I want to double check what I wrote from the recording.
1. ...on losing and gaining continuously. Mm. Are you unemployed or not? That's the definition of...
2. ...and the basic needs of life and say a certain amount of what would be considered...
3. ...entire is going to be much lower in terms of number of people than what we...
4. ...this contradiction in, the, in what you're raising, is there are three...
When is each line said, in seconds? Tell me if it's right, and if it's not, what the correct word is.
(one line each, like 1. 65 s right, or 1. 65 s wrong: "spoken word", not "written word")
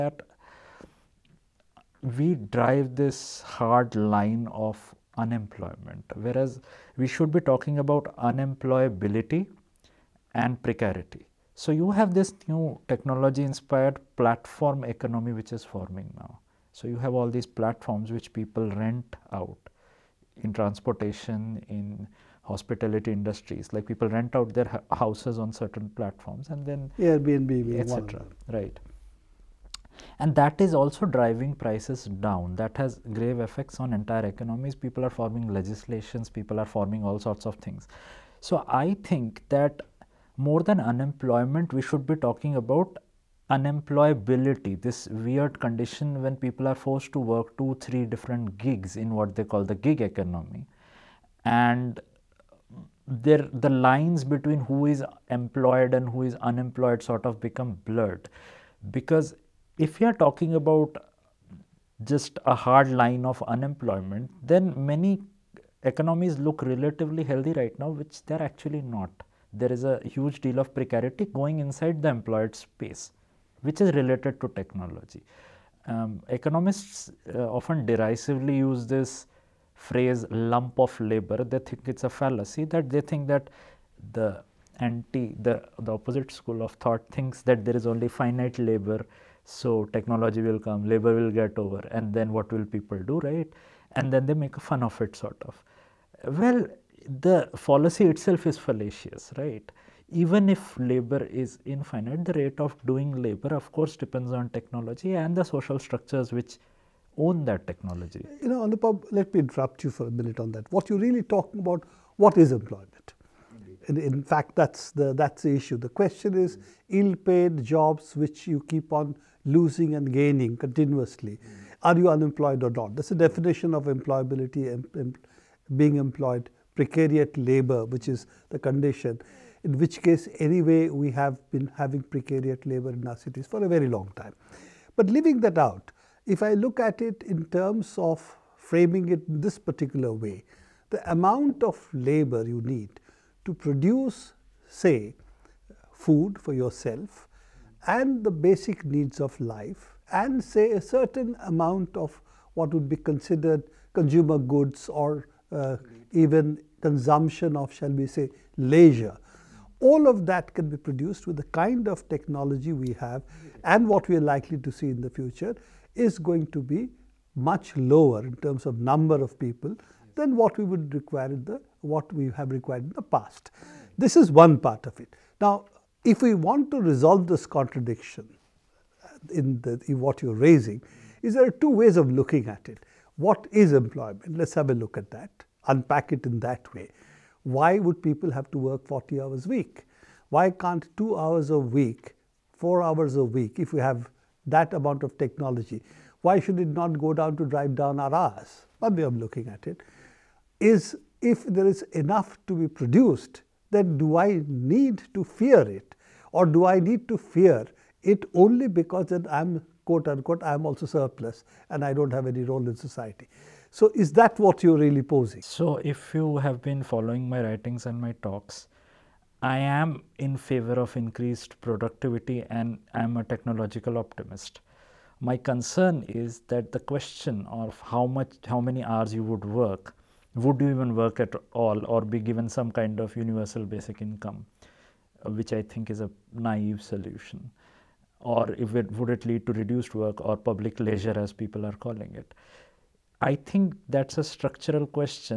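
1. 118 s right
2. 147 s right
3. 165 s wrong: "future", not "entire"
4. 177 s wrong: "two", not "three".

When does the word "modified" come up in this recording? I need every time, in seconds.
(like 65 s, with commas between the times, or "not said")
not said.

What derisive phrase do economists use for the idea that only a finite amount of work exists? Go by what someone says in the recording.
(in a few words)
lump of labor.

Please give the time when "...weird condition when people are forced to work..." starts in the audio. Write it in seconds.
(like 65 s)
45 s.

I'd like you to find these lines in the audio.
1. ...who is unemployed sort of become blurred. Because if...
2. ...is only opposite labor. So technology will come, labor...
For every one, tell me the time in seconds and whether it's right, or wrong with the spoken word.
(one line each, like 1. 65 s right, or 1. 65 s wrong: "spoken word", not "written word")
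1. 56 s right
2. 87 s wrong: "finite", not "opposite".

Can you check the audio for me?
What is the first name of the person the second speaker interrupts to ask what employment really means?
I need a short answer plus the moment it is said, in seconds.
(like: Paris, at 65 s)
Anupam, at 108 s.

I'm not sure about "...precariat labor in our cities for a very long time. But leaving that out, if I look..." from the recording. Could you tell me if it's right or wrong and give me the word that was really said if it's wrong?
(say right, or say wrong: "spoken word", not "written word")
right.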